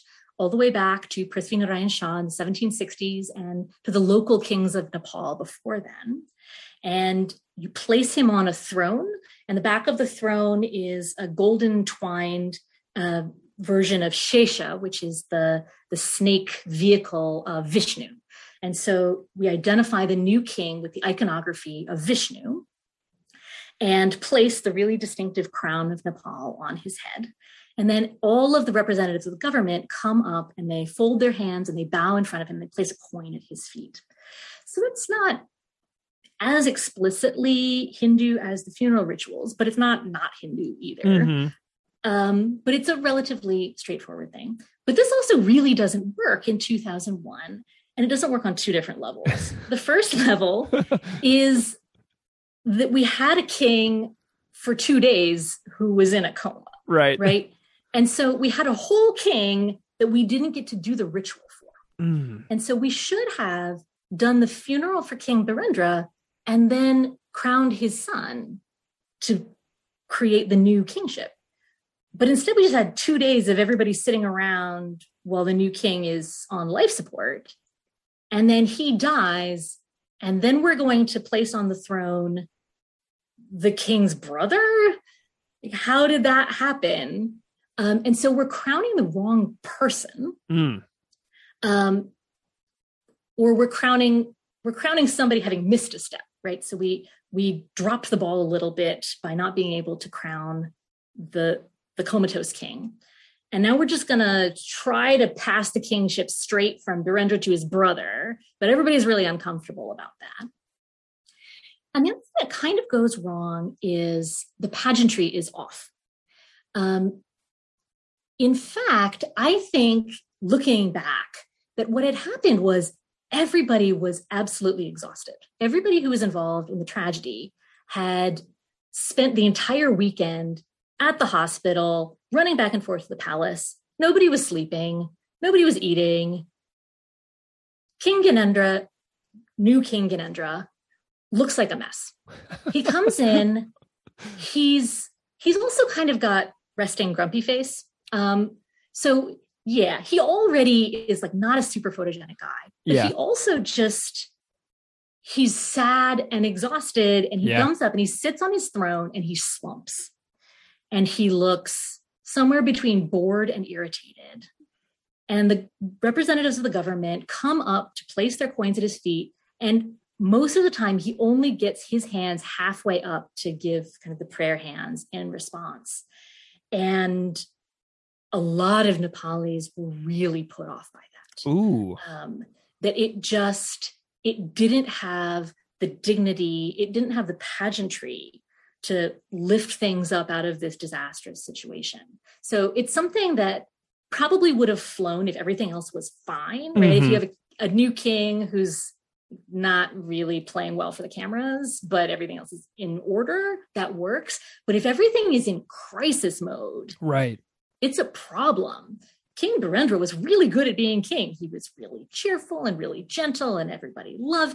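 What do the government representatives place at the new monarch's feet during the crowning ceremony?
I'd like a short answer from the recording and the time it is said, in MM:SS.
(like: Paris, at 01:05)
A coin, at 00:32.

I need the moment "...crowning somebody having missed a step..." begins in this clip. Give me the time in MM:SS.
01:34.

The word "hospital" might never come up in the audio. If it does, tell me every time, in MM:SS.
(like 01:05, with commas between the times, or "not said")
02:11.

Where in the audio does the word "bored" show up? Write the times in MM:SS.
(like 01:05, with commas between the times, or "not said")
02:43.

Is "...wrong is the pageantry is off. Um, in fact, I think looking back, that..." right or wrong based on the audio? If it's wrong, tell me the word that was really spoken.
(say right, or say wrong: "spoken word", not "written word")
right.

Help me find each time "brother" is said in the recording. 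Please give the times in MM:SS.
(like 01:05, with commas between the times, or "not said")
01:24, 01:47.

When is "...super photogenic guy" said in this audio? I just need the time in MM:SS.
02:31.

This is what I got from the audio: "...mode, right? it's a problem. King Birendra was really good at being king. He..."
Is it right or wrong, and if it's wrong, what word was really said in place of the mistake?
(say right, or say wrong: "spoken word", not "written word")
right.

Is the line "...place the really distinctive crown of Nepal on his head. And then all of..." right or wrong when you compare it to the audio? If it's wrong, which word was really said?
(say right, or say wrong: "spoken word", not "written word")
right.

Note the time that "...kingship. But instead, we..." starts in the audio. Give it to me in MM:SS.
01:10.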